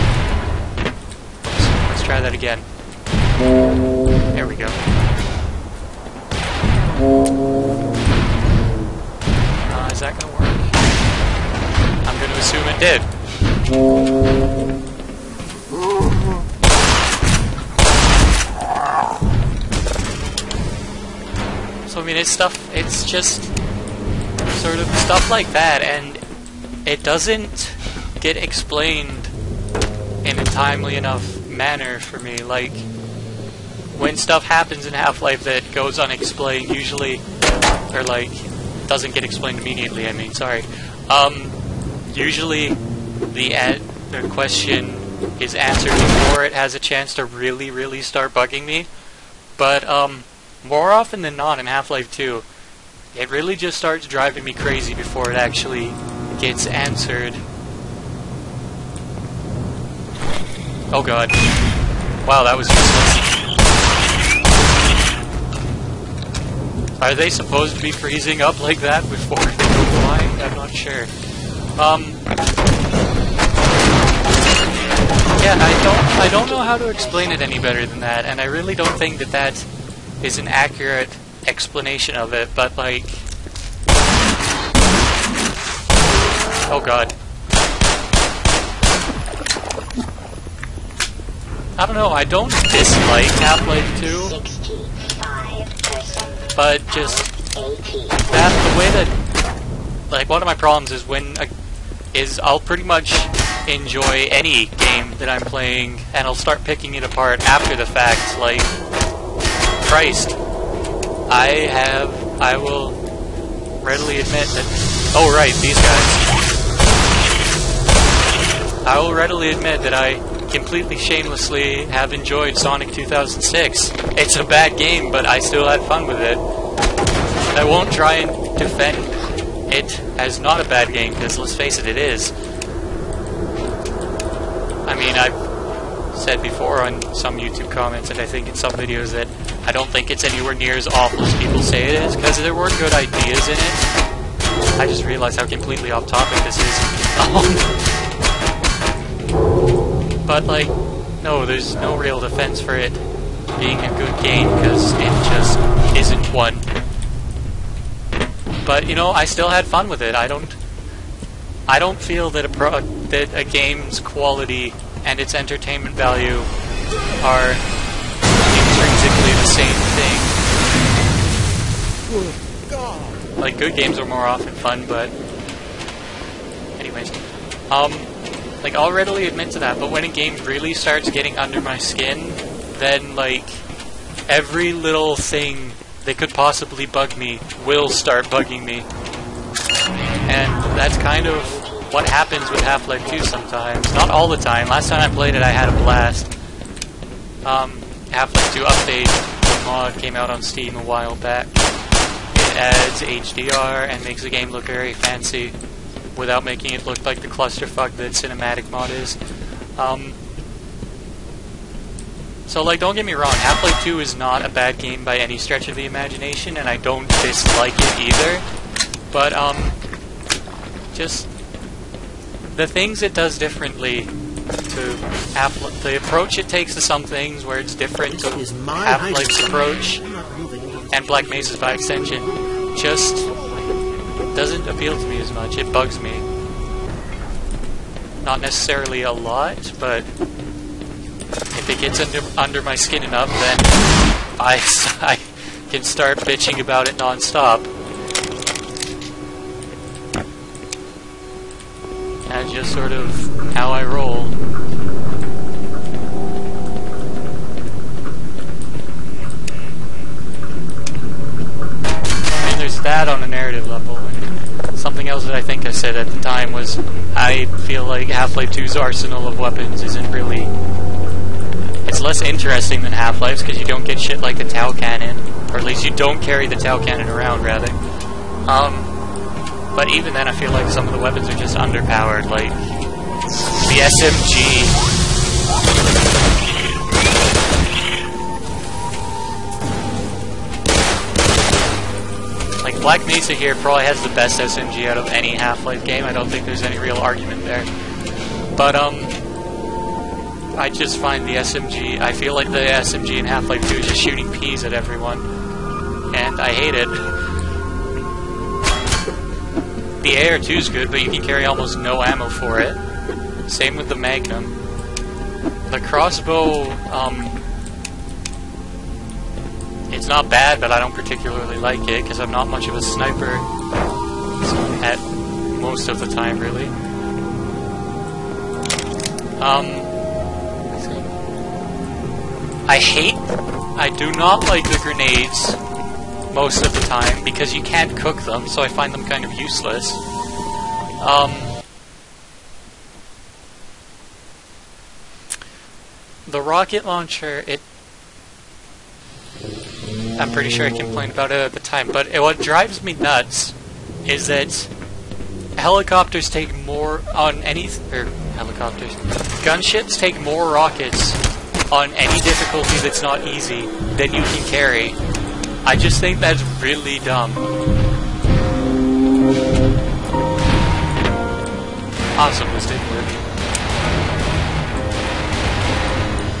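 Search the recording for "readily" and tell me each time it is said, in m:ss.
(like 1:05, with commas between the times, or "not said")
1:53, 1:59, 2:58.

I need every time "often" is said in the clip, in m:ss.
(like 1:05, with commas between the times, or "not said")
0:50, 2:54.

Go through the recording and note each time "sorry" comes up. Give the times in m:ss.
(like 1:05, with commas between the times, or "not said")
0:40.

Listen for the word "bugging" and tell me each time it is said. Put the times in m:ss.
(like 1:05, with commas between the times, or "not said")
0:48, 3:08.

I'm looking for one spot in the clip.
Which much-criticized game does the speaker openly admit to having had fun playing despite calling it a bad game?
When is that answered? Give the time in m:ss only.
2:02.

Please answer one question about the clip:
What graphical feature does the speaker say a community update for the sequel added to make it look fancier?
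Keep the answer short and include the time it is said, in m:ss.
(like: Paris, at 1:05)
HDR, at 3:23.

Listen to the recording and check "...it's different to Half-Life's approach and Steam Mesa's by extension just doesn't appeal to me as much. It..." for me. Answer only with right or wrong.
wrong.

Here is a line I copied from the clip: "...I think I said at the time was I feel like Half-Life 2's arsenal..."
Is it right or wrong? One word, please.
right.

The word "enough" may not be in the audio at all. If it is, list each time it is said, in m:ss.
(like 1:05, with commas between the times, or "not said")
0:30, 4:03.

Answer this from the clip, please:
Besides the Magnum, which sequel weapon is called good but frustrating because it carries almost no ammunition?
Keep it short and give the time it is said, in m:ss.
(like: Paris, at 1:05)
AR2, at 5:10.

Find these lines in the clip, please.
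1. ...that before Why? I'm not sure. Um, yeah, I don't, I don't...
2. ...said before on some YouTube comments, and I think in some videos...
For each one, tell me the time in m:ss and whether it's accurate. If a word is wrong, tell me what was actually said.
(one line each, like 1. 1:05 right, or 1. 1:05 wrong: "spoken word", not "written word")
1. 1:08 right
2. 2:16 right.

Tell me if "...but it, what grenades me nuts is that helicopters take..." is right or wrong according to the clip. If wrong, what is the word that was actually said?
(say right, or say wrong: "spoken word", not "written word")
wrong: "drives", not "grenades".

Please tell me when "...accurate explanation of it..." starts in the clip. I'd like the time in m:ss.
1:20.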